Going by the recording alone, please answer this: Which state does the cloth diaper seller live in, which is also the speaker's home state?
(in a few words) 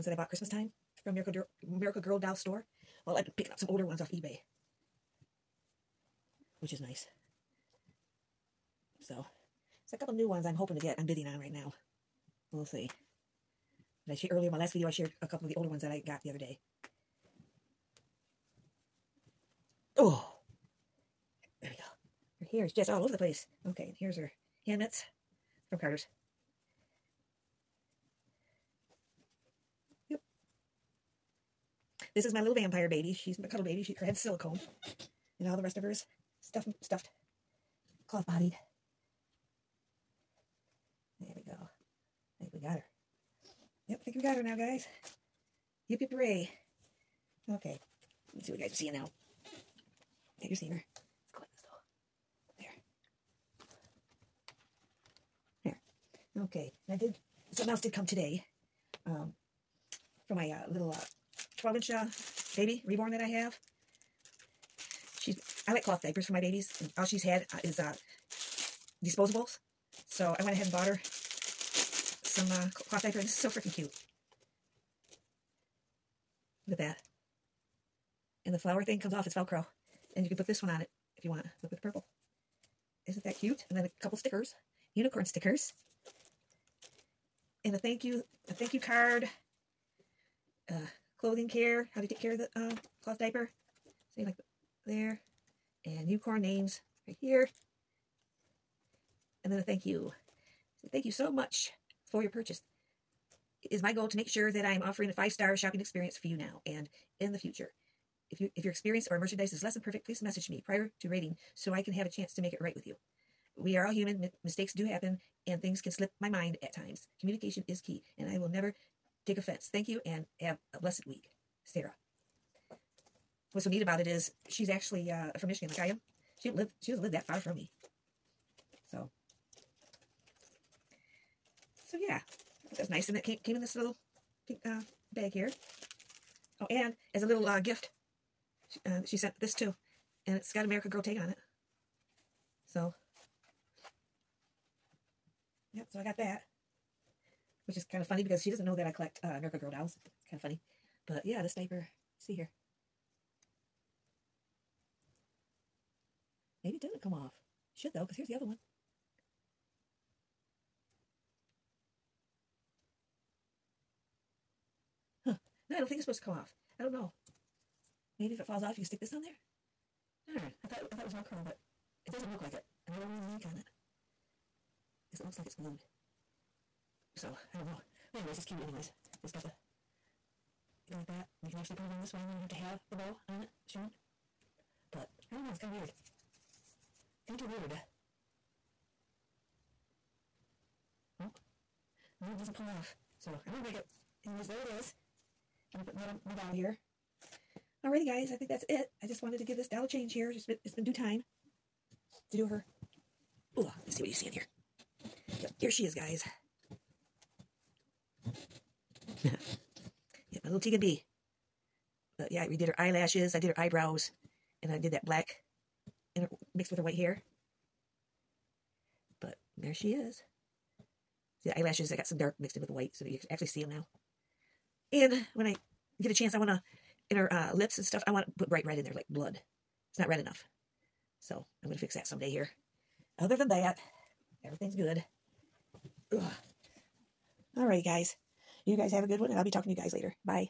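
Michigan.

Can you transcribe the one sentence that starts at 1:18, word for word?
And the flower thing comes off.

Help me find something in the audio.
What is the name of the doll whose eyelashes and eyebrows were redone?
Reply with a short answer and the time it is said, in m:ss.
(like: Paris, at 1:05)
Teagan Bee, at 3:30.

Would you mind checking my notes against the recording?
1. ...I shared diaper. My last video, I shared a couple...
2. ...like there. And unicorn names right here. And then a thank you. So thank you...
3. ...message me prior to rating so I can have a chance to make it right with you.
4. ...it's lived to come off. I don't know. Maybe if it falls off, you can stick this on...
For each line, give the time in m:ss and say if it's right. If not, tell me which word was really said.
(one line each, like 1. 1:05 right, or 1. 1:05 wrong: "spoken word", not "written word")
1. 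0:14 wrong: "earlier", not "diaper"
2. 1:34 right
3. 1:50 right
4. 2:45 wrong: "supposed", not "lived".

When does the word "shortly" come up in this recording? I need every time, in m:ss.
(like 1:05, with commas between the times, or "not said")
not said.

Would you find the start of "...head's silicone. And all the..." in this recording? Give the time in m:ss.
0:34.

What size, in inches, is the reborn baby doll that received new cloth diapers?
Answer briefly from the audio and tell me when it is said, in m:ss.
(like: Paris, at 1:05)
12, at 1:01.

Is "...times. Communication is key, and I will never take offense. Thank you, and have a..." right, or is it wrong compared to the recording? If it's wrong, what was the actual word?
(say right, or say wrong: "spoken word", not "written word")
right.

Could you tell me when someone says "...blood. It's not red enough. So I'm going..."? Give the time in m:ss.
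3:49.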